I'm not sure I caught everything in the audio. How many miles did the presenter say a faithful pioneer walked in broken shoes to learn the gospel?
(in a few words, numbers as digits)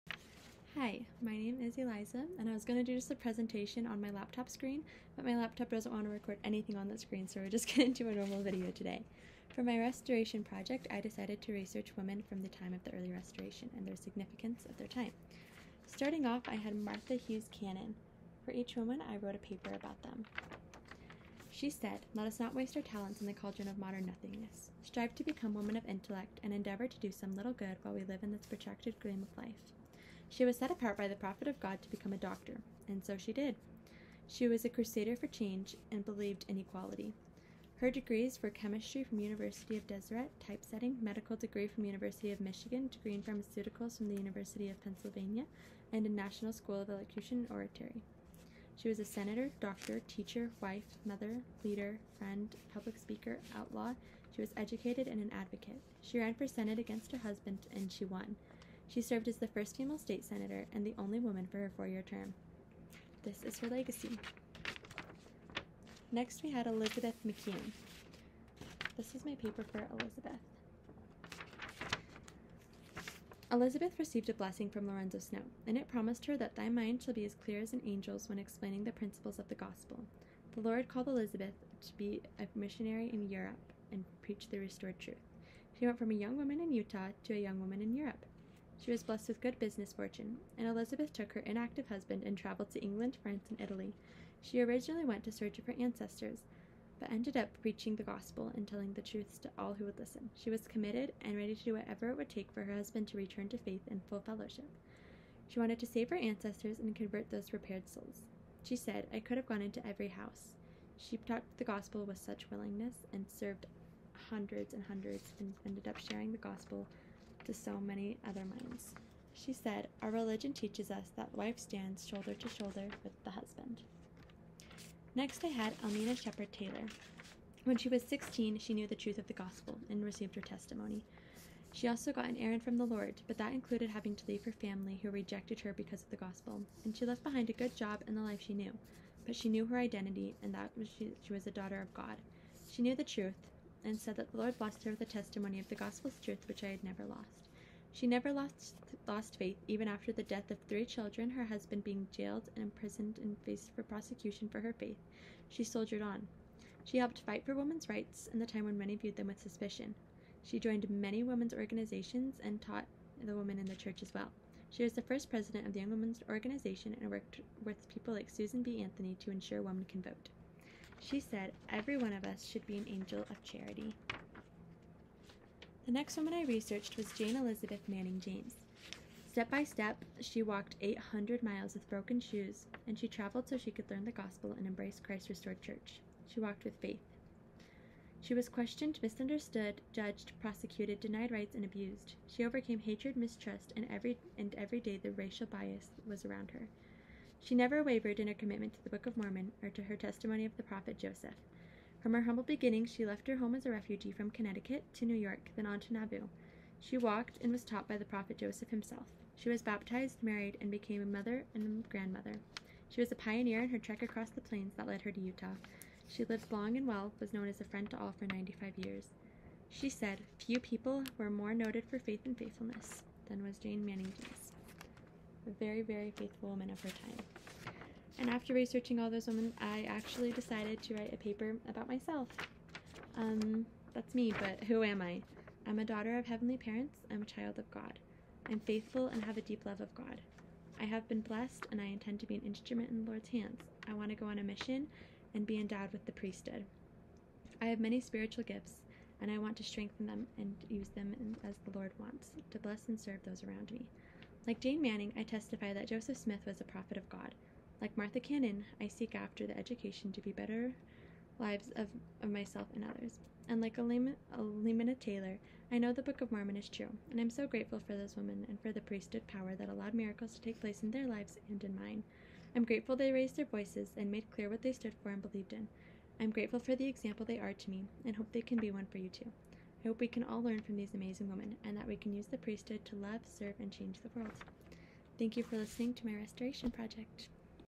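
800.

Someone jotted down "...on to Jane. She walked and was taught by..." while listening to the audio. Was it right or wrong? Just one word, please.
wrong.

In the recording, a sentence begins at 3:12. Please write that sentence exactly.
She overcame hatred, mistrust, and every and every day the racial bias was around her.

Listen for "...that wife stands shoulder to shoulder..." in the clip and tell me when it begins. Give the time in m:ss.
2:01.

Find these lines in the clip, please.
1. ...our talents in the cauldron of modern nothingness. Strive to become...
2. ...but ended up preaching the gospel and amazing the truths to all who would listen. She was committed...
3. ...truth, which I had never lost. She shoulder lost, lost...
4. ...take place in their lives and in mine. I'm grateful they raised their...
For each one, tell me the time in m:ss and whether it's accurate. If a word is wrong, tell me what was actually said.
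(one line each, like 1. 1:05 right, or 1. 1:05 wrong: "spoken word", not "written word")
1. 0:22 right
2. 1:36 wrong: "telling", not "amazing"
3. 2:26 wrong: "never", not "shoulder"
4. 4:30 right.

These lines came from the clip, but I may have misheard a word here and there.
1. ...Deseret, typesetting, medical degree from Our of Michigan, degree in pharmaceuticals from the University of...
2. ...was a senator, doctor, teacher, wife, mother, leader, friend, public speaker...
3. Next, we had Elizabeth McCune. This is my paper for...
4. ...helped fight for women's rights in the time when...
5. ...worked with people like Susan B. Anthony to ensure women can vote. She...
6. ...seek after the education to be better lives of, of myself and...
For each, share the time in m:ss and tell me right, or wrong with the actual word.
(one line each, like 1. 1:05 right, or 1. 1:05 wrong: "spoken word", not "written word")
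1. 0:39 wrong: "University", not "Our"
2. 0:48 right
3. 1:06 right
4. 2:36 right
5. 2:47 right
6. 4:18 right.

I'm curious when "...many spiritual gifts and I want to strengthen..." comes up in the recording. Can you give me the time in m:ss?
4:07.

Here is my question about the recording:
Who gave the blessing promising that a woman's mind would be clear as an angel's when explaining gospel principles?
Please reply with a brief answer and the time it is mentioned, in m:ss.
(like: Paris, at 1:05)
Lorenzo Snow, at 1:14.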